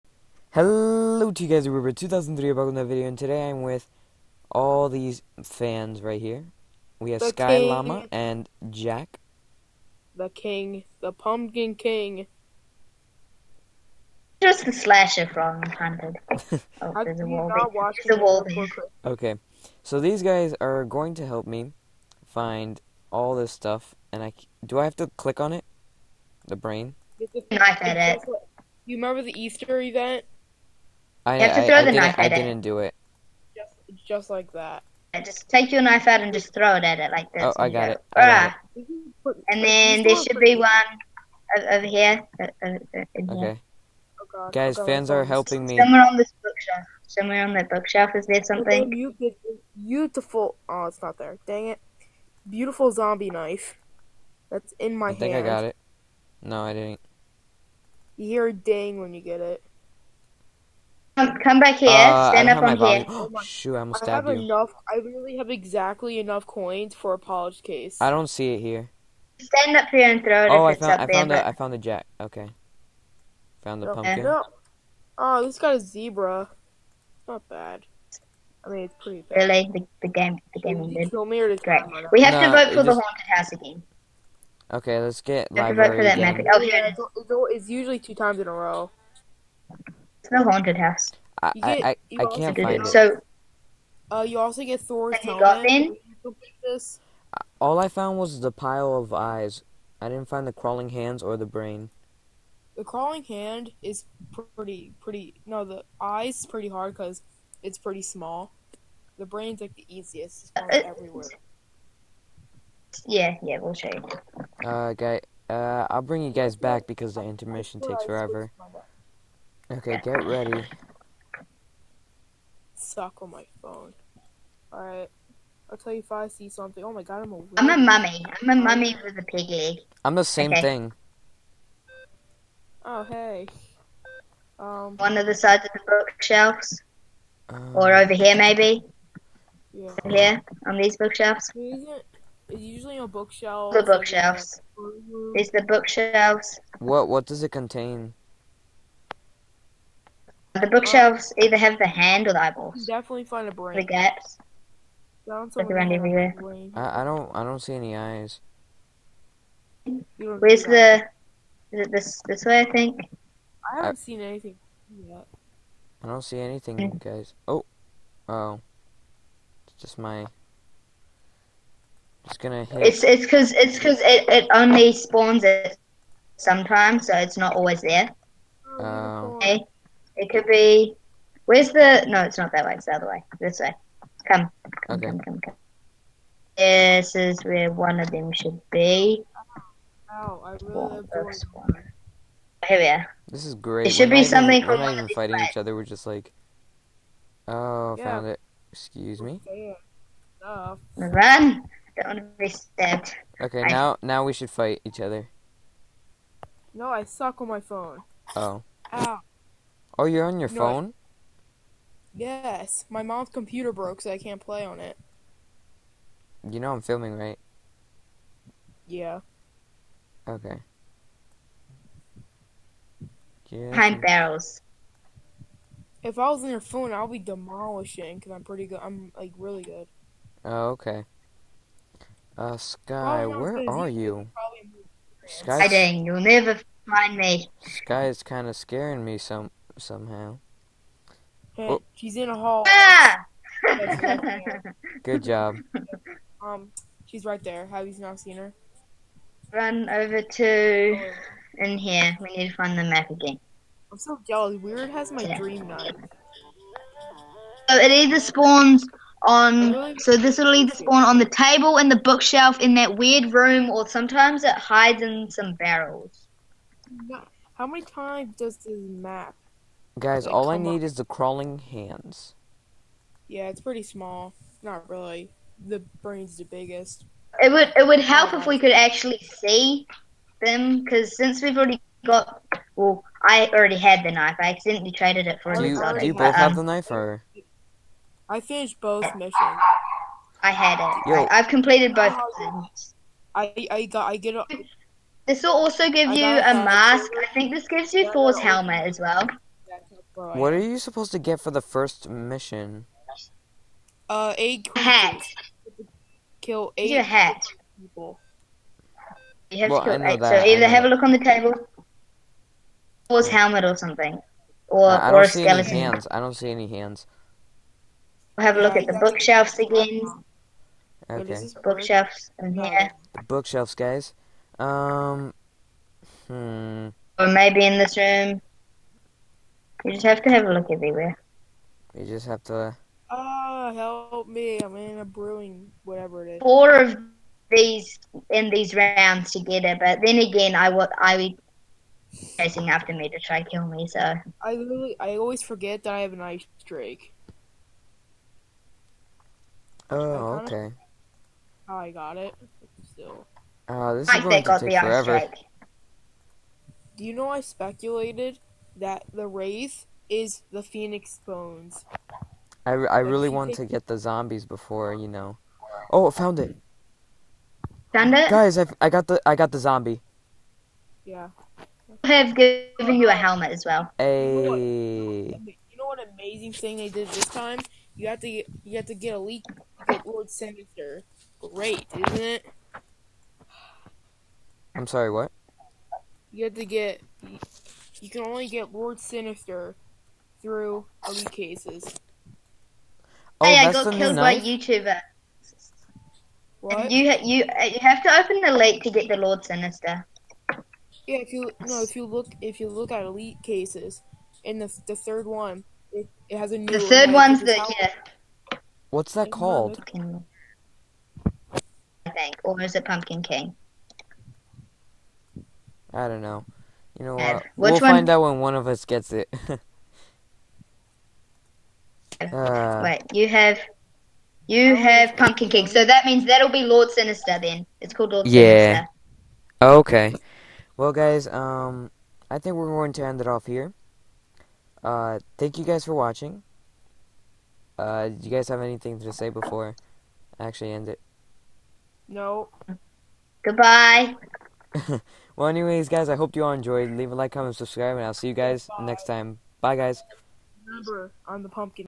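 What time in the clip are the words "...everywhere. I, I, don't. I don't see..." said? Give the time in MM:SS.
02:35.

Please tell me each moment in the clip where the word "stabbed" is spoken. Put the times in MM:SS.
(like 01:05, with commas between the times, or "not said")
01:04, 03:22.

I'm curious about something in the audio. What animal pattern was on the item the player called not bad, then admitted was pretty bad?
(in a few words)
Zebra.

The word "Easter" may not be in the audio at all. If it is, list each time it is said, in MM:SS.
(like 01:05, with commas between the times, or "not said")
00:29.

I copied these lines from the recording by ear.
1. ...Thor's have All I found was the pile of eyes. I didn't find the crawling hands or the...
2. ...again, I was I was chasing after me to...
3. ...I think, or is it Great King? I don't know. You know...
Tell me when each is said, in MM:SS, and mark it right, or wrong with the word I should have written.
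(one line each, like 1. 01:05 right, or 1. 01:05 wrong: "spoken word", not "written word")
1. 01:34 right
2. 05:40 right
3. 06:52 wrong: "Pumpkin", not "Great".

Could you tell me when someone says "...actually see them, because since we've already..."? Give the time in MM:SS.
04:38.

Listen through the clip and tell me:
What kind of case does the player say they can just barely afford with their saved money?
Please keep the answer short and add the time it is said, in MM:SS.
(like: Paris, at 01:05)
Polished case, at 01:07.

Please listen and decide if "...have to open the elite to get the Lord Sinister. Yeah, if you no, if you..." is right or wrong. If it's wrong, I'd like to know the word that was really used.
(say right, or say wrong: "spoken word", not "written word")
right.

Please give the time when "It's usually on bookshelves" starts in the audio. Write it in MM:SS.
02:21.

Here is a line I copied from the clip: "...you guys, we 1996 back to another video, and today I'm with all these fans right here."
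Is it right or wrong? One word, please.
wrong.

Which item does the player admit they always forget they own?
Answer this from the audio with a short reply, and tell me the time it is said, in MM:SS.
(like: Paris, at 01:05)
Ice drake, at 05:46.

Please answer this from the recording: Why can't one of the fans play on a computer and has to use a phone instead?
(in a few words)
Mom's computer broke.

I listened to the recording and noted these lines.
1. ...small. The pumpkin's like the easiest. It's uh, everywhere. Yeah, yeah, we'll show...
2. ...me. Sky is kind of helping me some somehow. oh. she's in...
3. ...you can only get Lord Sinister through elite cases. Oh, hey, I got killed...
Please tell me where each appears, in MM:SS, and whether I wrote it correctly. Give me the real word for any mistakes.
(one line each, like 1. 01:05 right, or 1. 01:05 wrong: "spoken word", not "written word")
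1. 01:48 wrong: "brain", not "pumpkin"
2. 03:57 wrong: "scaring", not "helping"
3. 06:28 right.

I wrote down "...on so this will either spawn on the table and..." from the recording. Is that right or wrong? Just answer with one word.
right.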